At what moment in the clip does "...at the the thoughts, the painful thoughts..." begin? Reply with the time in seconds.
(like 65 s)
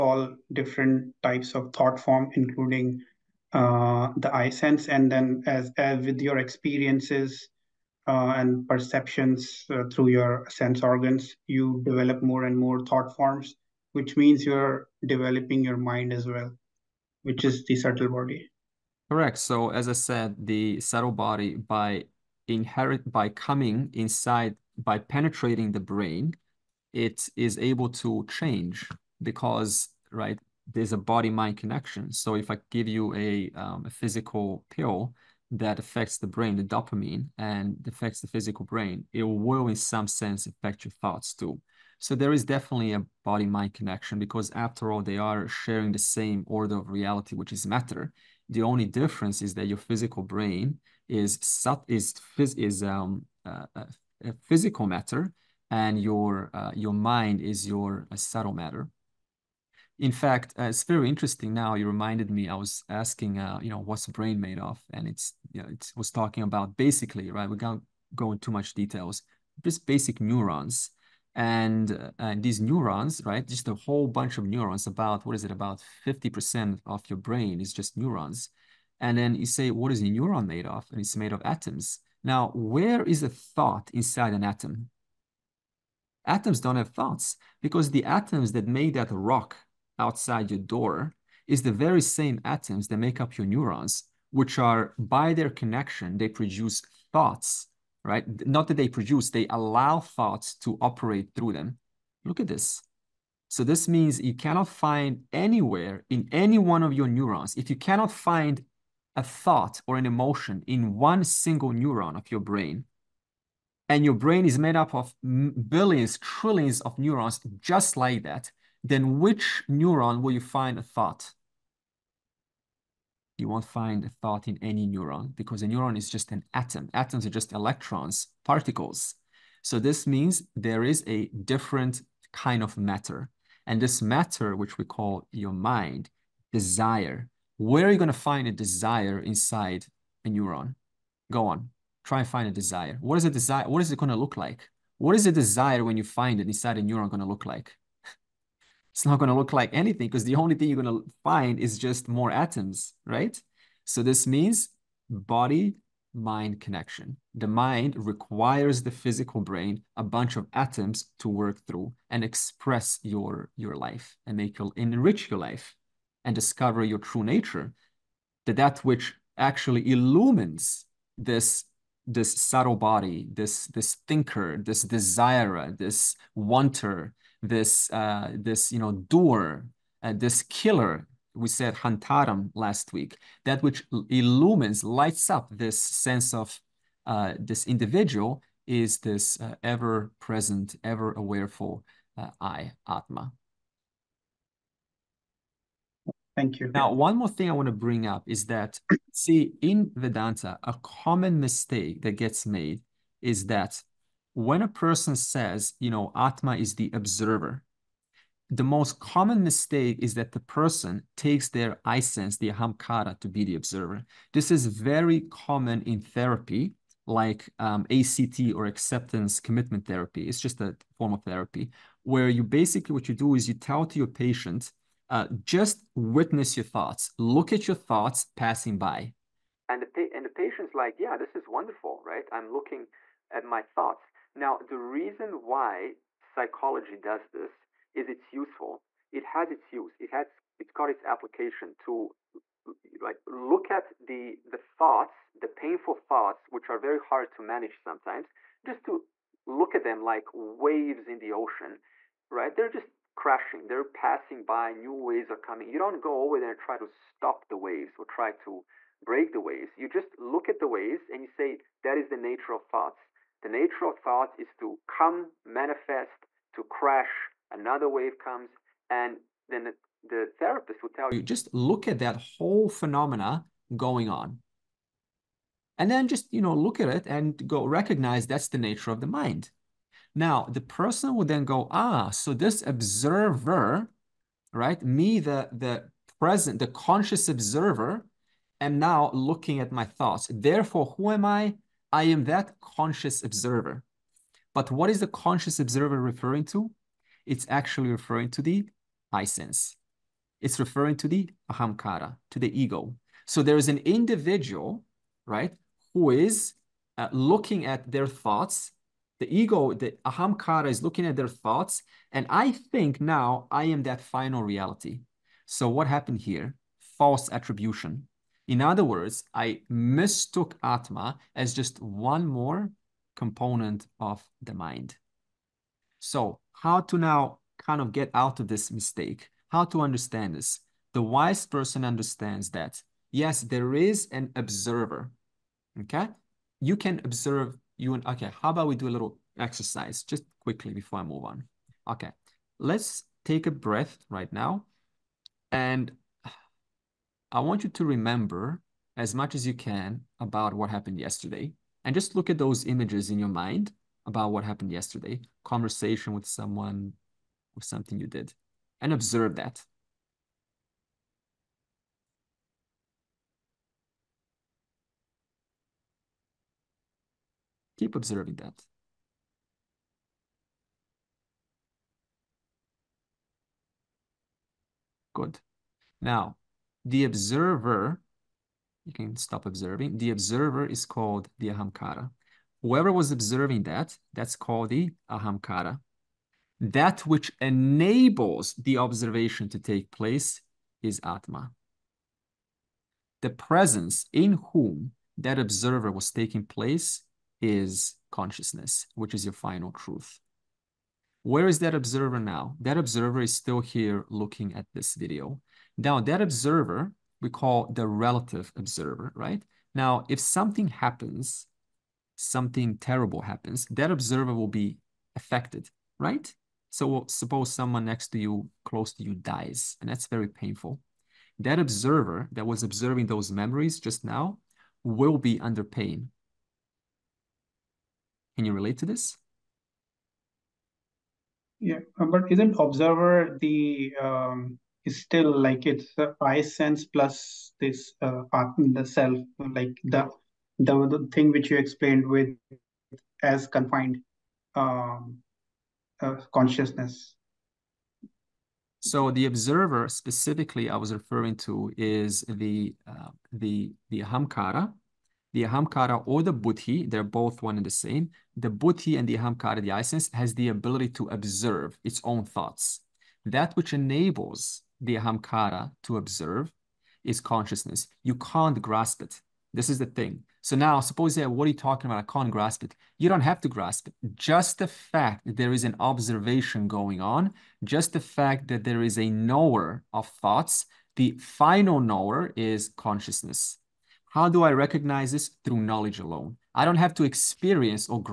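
243 s.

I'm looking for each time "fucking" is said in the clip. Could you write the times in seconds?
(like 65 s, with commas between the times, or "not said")
not said.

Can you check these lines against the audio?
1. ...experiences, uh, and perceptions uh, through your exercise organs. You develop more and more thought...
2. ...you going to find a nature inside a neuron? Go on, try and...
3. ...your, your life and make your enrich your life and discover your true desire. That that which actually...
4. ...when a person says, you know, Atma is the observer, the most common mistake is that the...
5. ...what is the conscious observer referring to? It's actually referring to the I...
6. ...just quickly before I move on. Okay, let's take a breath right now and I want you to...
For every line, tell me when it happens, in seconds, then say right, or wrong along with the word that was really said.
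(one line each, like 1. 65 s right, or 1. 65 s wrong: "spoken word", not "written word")
1. 6 s wrong: "sense", not "exercise"
2. 137 s wrong: "desire", not "nature"
3. 163 s wrong: "nature", not "desire"
4. 204 s right
5. 294 s right
6. 340 s right.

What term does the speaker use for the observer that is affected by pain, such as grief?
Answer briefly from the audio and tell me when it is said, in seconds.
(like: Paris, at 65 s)
relative observer, at 407 s.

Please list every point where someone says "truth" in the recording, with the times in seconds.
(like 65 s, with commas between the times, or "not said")
399 s.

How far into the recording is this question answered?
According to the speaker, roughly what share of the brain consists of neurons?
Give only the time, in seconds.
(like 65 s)
76 s.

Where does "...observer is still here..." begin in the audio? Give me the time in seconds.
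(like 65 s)
402 s.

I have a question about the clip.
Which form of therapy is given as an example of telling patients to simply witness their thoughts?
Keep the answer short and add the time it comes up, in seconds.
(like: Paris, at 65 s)
acceptance commitment therapy, at 218 s.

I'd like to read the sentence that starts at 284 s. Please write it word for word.
Me, the, the present, the conscious observer am now looking at my thoughts.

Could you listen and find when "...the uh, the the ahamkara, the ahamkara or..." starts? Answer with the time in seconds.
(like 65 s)
452 s.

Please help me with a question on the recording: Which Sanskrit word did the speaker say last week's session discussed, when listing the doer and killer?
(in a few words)
hantaram.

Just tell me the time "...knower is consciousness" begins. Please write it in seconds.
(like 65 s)
481 s.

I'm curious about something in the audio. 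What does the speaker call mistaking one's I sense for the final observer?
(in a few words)
false attribution.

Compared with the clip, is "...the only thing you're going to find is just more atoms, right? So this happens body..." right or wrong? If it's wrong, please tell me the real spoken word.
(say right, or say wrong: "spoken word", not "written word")
wrong: "means", not "happens".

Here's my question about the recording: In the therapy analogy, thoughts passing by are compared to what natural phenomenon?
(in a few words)
waves in the ocean.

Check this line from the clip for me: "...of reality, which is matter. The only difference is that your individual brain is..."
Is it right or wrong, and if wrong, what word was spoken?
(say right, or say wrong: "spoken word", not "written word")
wrong: "physical", not "individual".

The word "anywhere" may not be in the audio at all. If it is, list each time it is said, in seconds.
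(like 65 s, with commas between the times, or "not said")
105 s.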